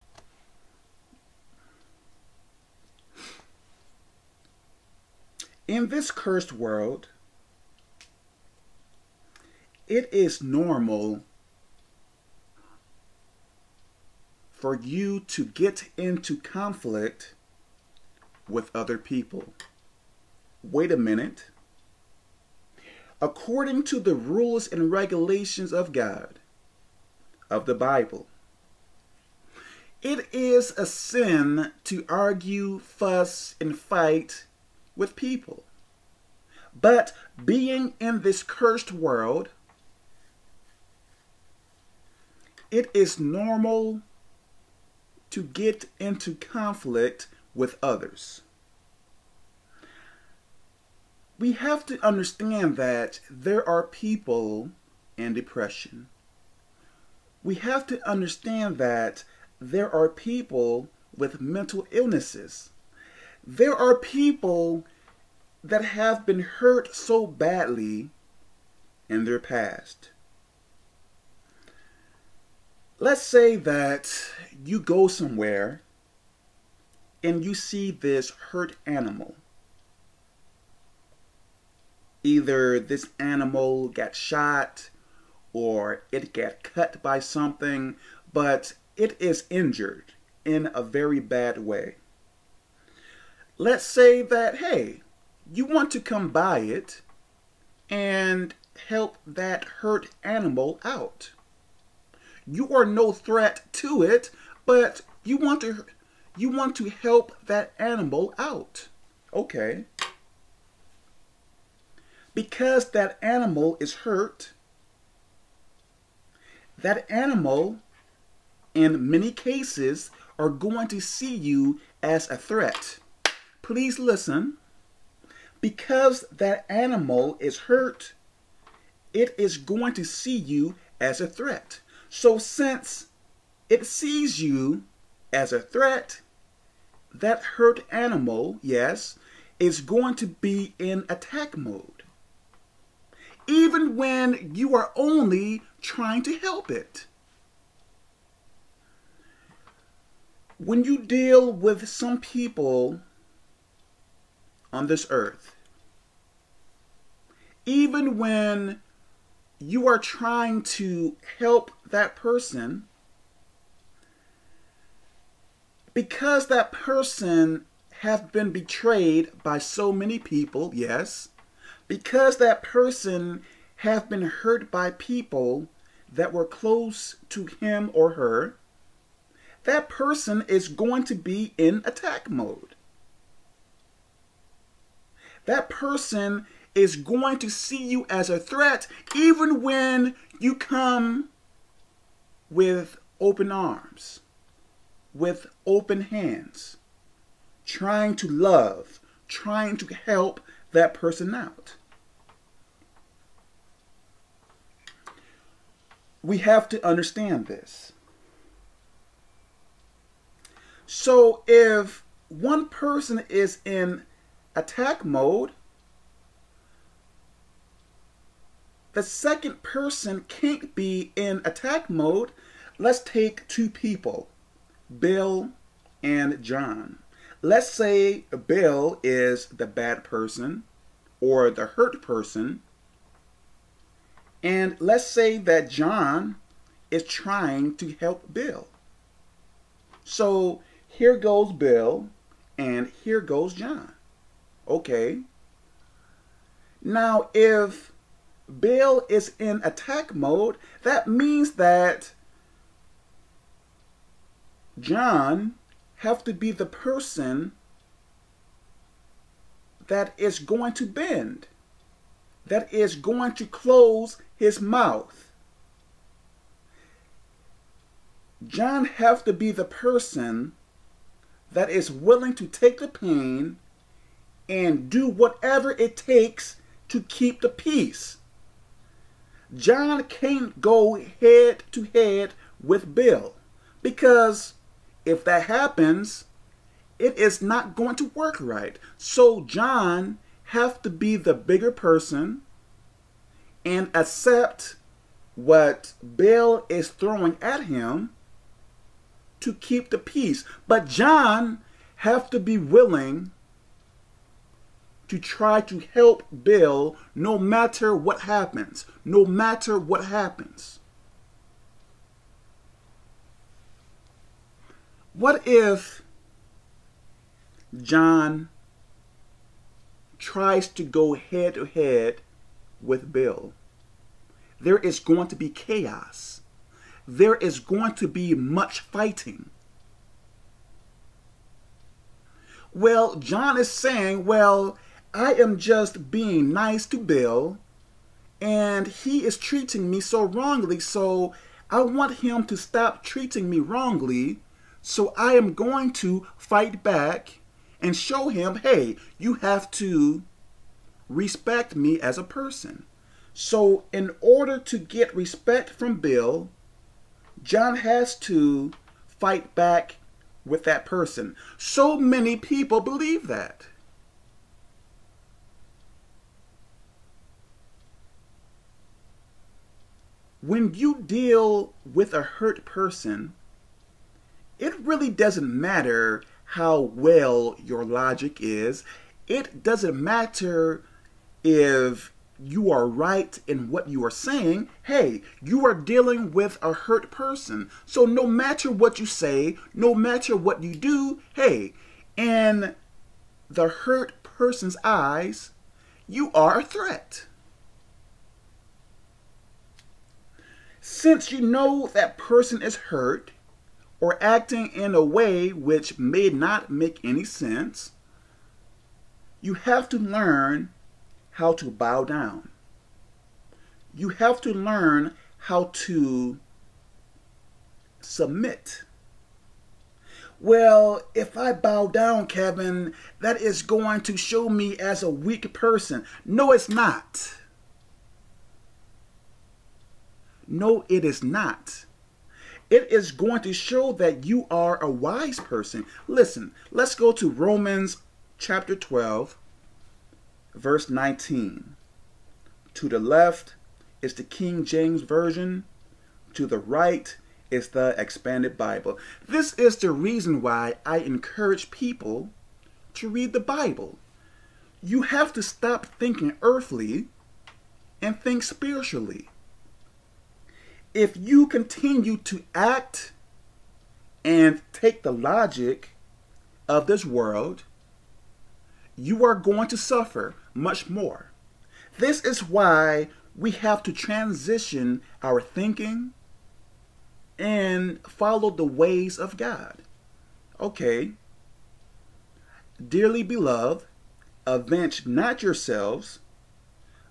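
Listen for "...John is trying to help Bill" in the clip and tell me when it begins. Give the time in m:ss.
3:55.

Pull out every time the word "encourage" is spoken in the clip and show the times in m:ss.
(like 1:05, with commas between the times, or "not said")
7:30.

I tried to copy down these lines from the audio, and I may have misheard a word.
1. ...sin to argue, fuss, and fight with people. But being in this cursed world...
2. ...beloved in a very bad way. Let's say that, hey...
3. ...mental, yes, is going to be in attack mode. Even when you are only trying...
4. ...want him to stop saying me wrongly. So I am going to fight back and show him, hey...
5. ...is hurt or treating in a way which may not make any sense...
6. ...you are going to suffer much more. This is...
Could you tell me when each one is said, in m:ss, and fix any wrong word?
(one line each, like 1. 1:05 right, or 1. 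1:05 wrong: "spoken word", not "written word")
1. 0:30 right
2. 1:29 wrong: "injured", not "beloved"
3. 2:17 wrong: "animal", not "mental"
4. 5:41 wrong: "treating", not "saying"
5. 6:42 wrong: "acting", not "treating"
6. 7:48 right.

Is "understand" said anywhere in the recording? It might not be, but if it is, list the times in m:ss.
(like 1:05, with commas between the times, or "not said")
0:52, 0:58, 3:26.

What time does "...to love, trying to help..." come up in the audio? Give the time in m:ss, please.
3:18.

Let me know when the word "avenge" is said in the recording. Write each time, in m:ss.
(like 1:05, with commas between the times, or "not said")
8:04.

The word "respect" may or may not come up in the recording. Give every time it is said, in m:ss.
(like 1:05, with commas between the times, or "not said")
5:51, 5:55.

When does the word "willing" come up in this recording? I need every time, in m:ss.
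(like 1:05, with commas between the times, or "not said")
4:31, 5:02.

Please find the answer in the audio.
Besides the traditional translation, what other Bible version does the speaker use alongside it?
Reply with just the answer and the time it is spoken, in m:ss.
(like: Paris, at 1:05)
Expanded Bible, at 7:27.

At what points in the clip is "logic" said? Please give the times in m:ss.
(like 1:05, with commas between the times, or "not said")
6:17, 7:45.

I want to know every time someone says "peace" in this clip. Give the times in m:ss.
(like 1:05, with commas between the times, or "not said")
4:37, 4:59.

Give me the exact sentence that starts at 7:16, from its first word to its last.
Listen, let's go to Romans chapter 12, verse 19.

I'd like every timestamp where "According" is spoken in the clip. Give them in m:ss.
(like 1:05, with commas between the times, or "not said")
0:23.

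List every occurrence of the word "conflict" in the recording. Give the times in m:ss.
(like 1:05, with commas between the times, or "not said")
0:16, 0:46.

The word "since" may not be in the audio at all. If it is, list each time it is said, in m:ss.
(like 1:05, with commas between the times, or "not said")
2:12, 6:40.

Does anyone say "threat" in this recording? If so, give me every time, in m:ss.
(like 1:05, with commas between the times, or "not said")
1:43, 2:02, 2:11, 2:15, 3:08, 6:36.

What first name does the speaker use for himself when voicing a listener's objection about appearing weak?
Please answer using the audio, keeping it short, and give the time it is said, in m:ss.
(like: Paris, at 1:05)
Kevin, at 7:02.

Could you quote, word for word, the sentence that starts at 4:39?
John can't go head to head with Bill because if that happens, it is not going to work right.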